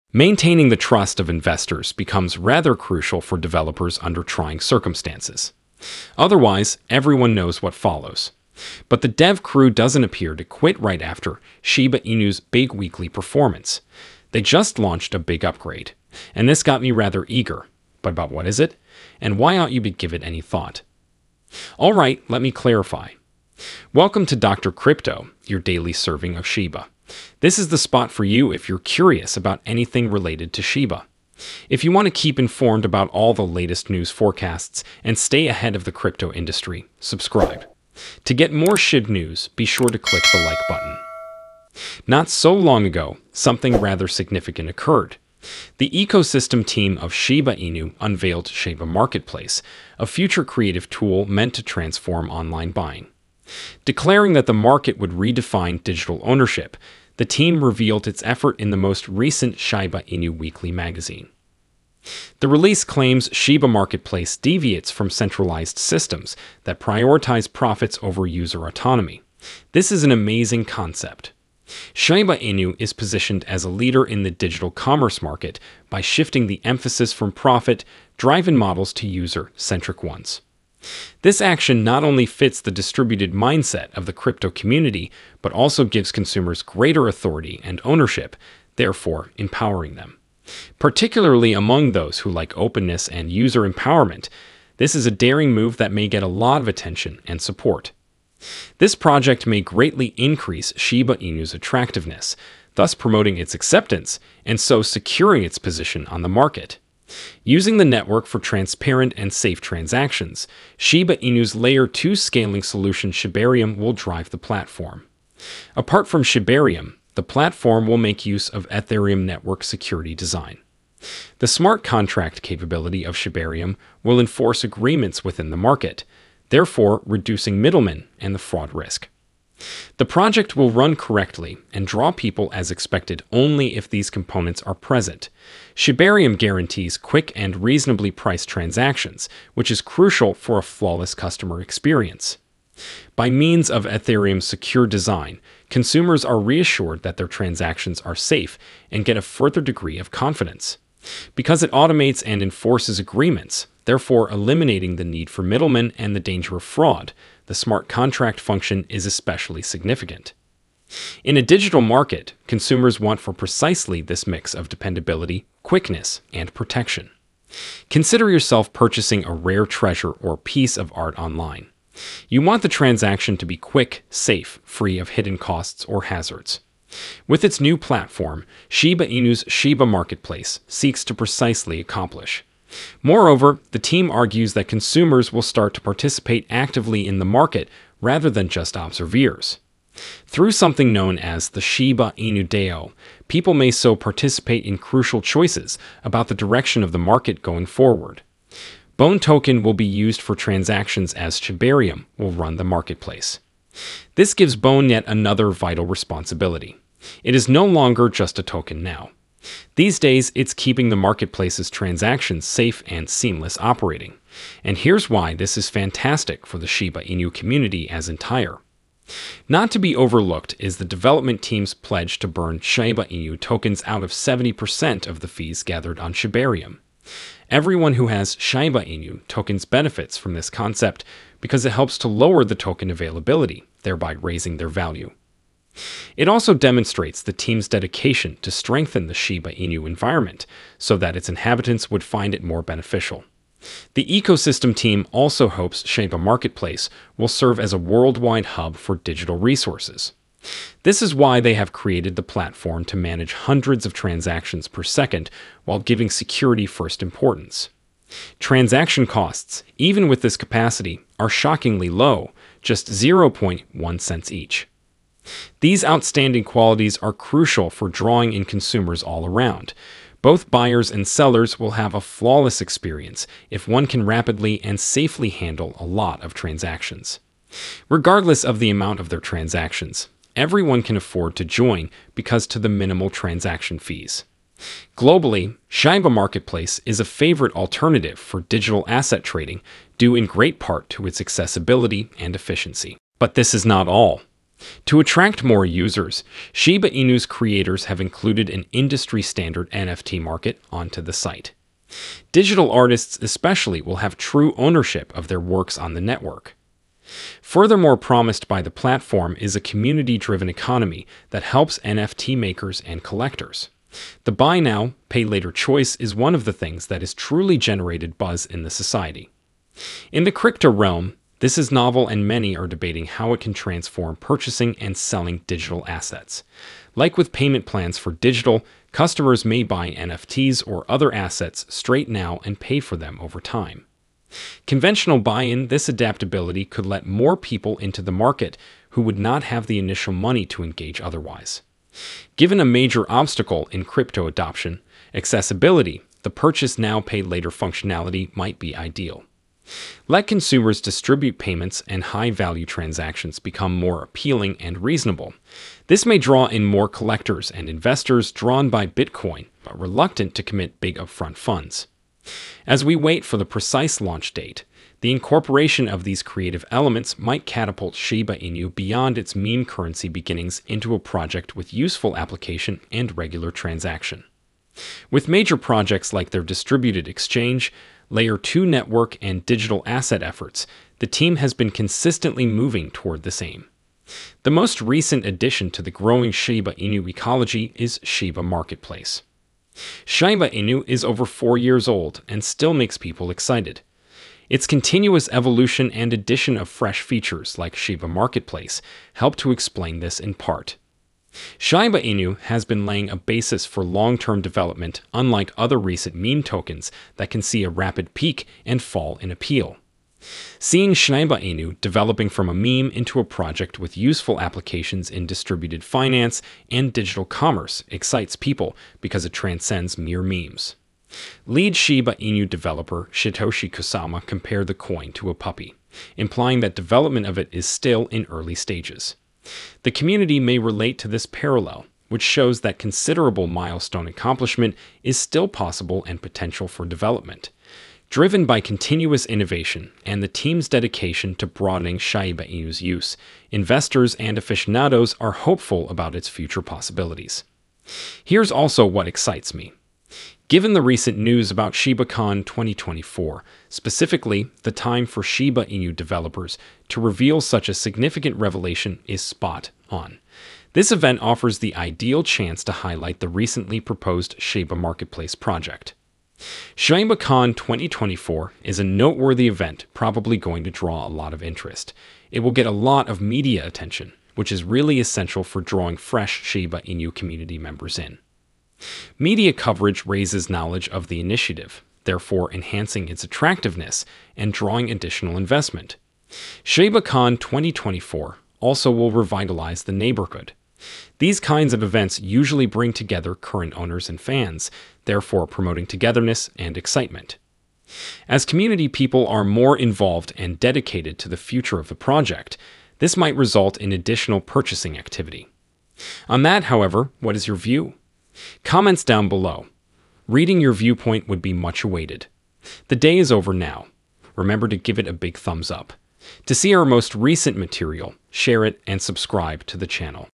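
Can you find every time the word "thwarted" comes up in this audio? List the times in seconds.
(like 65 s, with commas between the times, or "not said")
not said.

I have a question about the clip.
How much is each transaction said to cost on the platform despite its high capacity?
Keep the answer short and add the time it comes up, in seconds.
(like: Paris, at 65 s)
0.1 cents, at 262 s.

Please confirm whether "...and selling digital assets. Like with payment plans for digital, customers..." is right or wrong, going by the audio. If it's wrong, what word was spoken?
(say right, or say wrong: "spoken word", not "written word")
right.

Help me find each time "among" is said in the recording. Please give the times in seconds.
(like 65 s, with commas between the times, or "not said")
91 s.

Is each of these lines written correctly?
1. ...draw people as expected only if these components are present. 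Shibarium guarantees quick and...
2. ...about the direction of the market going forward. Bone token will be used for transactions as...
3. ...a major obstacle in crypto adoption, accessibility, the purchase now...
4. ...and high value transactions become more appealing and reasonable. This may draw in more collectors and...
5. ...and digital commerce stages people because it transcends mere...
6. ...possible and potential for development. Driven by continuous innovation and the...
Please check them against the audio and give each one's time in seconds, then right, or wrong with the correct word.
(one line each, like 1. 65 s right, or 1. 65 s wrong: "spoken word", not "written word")
1. 131 s right
2. 196 s right
3. 342 s right
4. 351 s right
5. 416 s wrong: "excites", not "stages"
6. 435 s right.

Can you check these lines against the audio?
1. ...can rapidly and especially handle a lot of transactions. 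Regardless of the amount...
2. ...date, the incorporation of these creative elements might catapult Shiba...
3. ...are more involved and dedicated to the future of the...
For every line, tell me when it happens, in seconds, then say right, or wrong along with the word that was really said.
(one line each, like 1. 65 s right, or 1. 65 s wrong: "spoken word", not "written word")
1. 273 s wrong: "safely", not "especially"
2. 364 s right
3. 499 s right.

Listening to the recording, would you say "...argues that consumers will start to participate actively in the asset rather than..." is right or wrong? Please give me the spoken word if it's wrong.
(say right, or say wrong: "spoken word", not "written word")
wrong: "market", not "asset".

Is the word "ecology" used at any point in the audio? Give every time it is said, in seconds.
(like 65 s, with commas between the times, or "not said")
387 s.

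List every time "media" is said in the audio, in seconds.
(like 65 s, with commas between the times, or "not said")
473 s, 479 s.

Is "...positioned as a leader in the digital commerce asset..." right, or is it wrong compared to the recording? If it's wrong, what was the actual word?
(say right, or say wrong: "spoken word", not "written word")
wrong: "market", not "asset".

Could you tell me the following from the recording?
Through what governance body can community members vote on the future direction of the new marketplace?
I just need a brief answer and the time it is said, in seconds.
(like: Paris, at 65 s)
Shiba Inu DAO, at 191 s.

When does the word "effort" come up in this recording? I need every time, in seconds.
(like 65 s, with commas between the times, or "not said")
58 s, 380 s.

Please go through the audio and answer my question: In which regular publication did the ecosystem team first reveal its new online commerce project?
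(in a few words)
Shiba Inu Weekly.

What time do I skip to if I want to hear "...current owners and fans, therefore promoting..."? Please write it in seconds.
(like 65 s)
493 s.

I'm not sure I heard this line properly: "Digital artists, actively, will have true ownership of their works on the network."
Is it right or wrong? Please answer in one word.
wrong.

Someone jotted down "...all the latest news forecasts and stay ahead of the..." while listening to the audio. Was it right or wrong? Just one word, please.
right.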